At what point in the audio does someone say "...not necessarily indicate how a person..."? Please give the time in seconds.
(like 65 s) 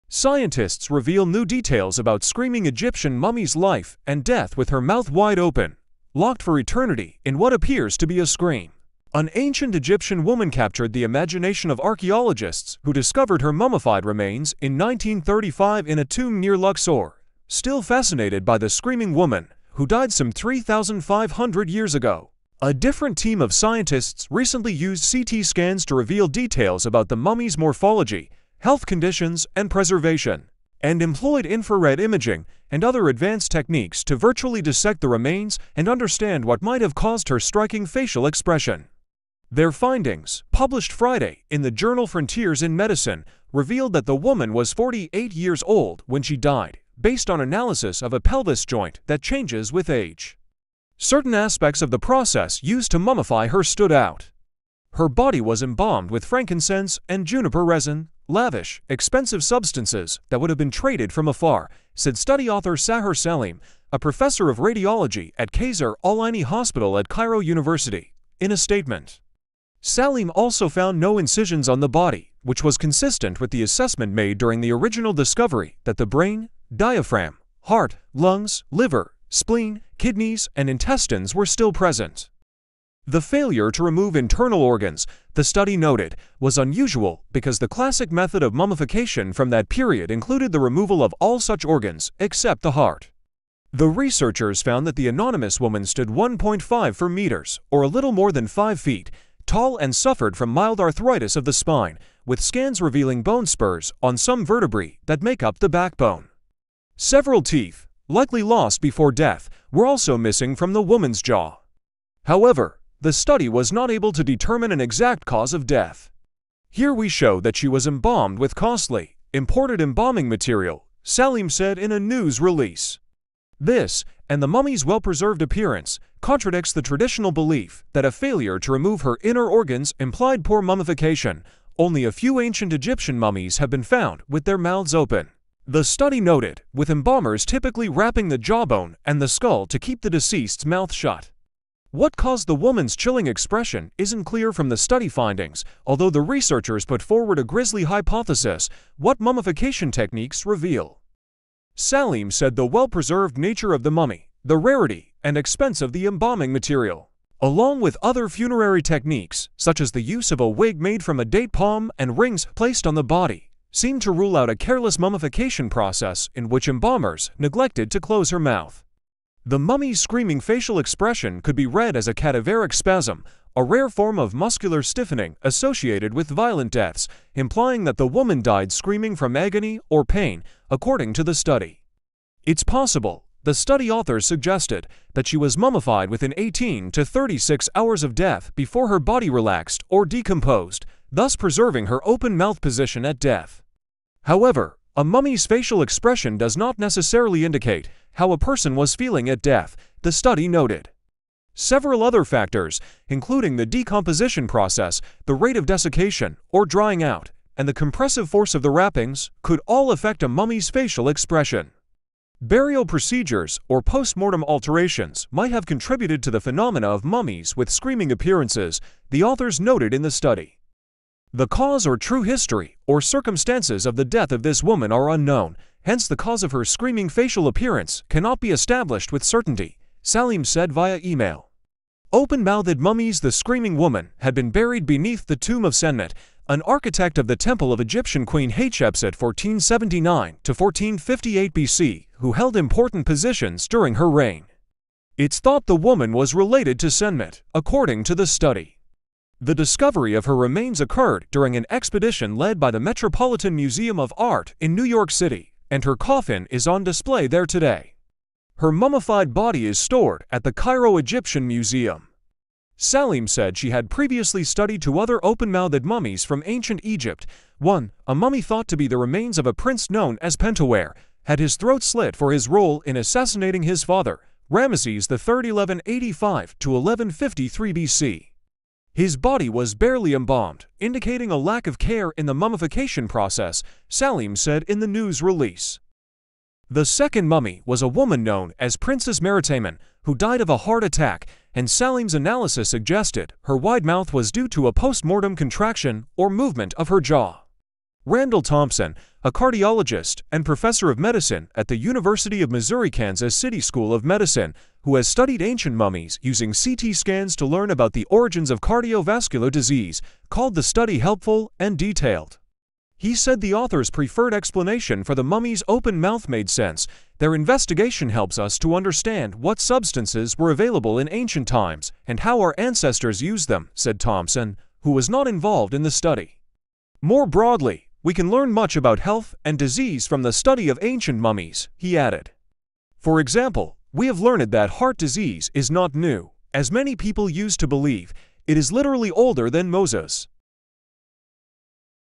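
196 s.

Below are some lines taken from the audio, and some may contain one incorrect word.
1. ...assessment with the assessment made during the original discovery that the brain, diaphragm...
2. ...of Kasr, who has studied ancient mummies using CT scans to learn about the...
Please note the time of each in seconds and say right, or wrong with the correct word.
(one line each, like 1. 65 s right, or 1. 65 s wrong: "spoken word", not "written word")
1. 72 s wrong: "consistent", not "assessment"
2. 303 s wrong: "Medicine", not "Kasr".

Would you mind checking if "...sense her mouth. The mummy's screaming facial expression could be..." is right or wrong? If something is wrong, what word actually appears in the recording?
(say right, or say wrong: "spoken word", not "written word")
wrong: "close", not "sense".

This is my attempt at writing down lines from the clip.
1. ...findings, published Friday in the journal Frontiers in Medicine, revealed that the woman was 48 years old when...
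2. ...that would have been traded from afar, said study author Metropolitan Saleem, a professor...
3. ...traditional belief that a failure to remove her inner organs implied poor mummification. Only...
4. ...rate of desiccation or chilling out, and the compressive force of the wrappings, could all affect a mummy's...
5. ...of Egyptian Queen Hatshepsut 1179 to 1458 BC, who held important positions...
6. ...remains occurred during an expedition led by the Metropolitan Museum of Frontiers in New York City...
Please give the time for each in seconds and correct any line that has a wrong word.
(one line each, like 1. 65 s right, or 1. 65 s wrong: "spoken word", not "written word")
1. 39 s right
2. 60 s wrong: "Sahar", not "Metropolitan"
3. 126 s right
4. 205 s wrong: "drying", not "chilling"
5. 237 s wrong: "1479", not "1179"
6. 250 s wrong: "Art", not "Frontiers".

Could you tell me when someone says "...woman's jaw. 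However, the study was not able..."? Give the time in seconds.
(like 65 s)
110 s.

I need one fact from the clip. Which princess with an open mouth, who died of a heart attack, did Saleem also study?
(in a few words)
Meritamen.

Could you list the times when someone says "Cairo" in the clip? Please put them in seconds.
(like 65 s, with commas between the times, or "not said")
67 s, 260 s.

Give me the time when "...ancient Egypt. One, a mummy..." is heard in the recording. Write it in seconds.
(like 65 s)
266 s.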